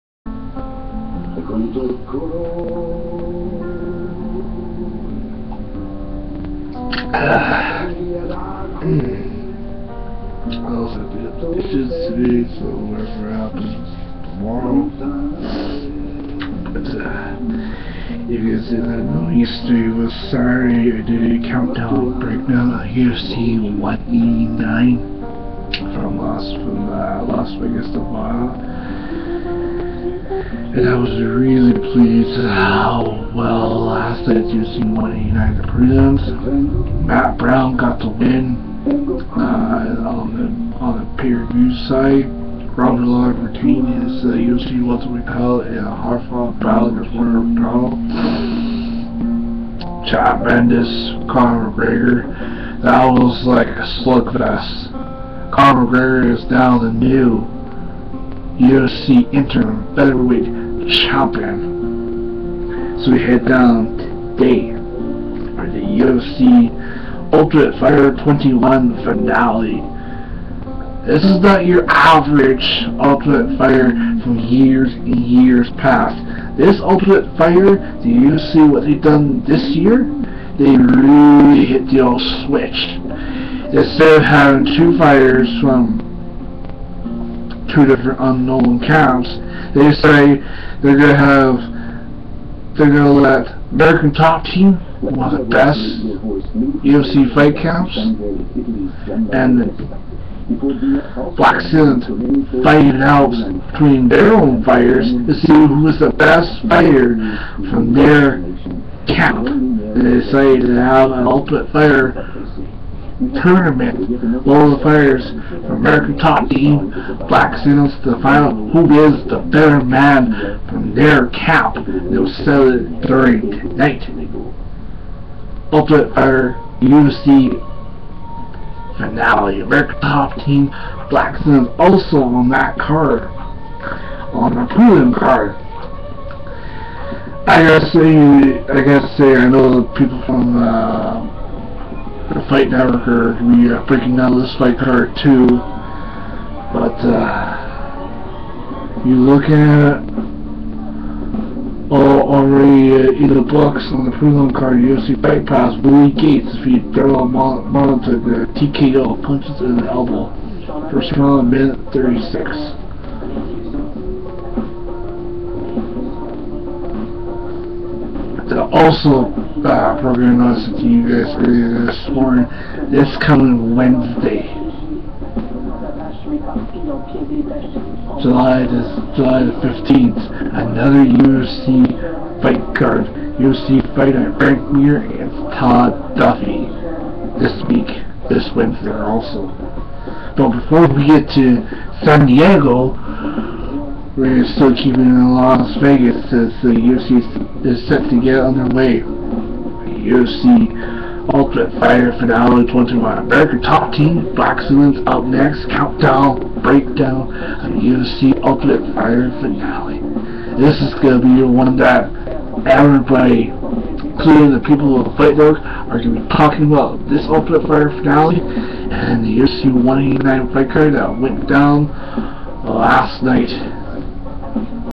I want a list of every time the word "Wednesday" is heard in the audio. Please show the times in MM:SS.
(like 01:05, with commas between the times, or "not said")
02:53, 03:08.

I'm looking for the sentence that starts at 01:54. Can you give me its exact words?
world the from American Top Team Blackzilians to the final who is the better man from their camp.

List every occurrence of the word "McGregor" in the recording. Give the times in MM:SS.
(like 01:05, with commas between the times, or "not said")
00:51, 00:55.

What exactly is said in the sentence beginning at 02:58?
July the, July the 15th, another UFC fight card.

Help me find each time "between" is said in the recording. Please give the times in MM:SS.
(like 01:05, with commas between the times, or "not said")
01:43.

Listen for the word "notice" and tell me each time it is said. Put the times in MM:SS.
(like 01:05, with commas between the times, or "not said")
02:50.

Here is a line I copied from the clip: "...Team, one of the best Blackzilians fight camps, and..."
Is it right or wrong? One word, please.
wrong.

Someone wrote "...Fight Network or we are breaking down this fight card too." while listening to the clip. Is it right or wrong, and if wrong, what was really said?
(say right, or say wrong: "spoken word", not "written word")
right.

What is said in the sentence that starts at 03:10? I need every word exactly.
But before we get to San Diego, we're still keeping in Las Vegas as the UFC is set to get underway.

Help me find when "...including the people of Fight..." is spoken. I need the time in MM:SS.
03:34.